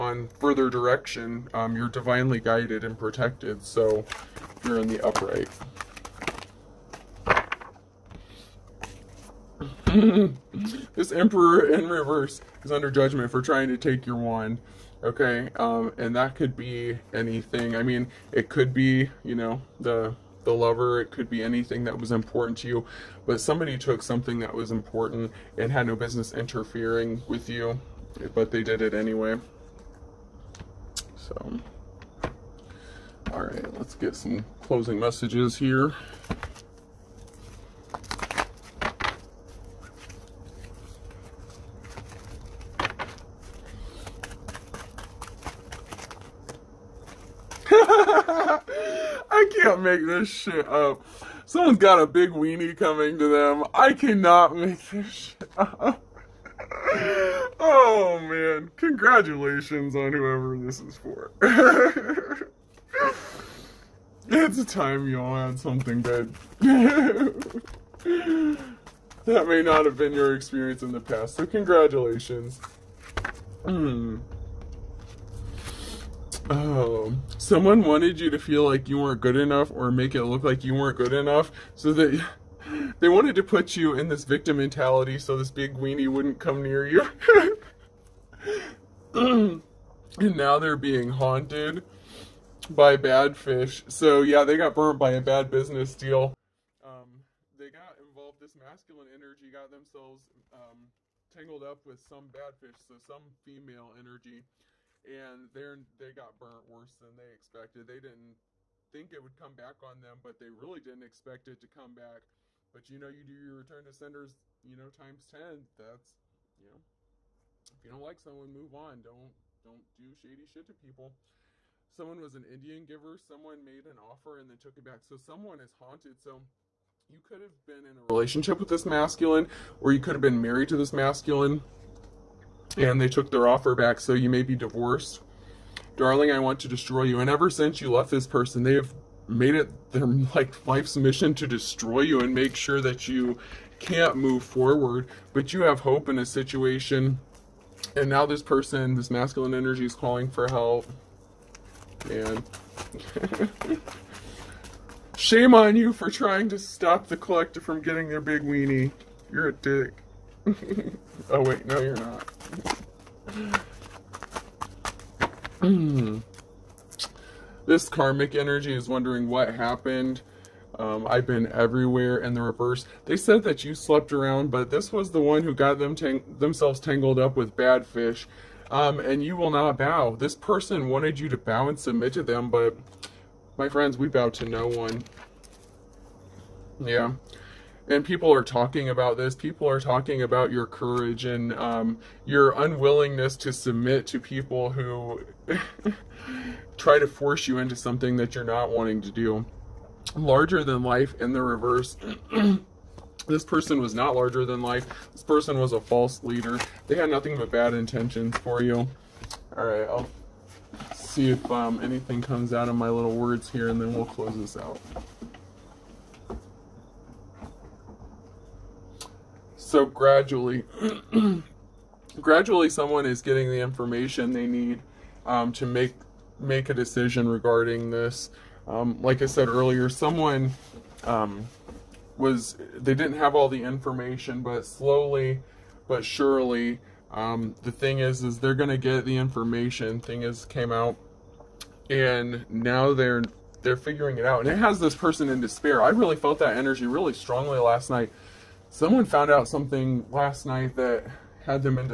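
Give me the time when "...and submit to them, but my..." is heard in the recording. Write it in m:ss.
3:01.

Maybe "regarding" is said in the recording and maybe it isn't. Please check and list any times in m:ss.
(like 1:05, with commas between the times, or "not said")
3:47.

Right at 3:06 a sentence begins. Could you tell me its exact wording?
Yeah and people are talking about this.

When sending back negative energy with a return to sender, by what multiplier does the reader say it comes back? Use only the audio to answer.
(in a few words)
Times ten.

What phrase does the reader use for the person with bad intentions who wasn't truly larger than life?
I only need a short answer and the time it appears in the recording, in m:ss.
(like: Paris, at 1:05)
False leader, at 3:25.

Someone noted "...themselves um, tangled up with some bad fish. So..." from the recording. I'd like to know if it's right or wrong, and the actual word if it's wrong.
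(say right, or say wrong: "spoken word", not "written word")
right.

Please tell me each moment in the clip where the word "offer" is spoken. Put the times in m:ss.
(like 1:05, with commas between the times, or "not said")
2:03, 2:13.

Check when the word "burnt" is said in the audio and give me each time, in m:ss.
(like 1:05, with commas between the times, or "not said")
1:34, 1:46.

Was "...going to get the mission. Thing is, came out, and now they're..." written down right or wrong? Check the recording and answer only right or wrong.
wrong.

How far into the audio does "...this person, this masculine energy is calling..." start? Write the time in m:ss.
2:28.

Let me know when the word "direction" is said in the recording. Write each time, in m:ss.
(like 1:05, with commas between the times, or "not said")
0:00.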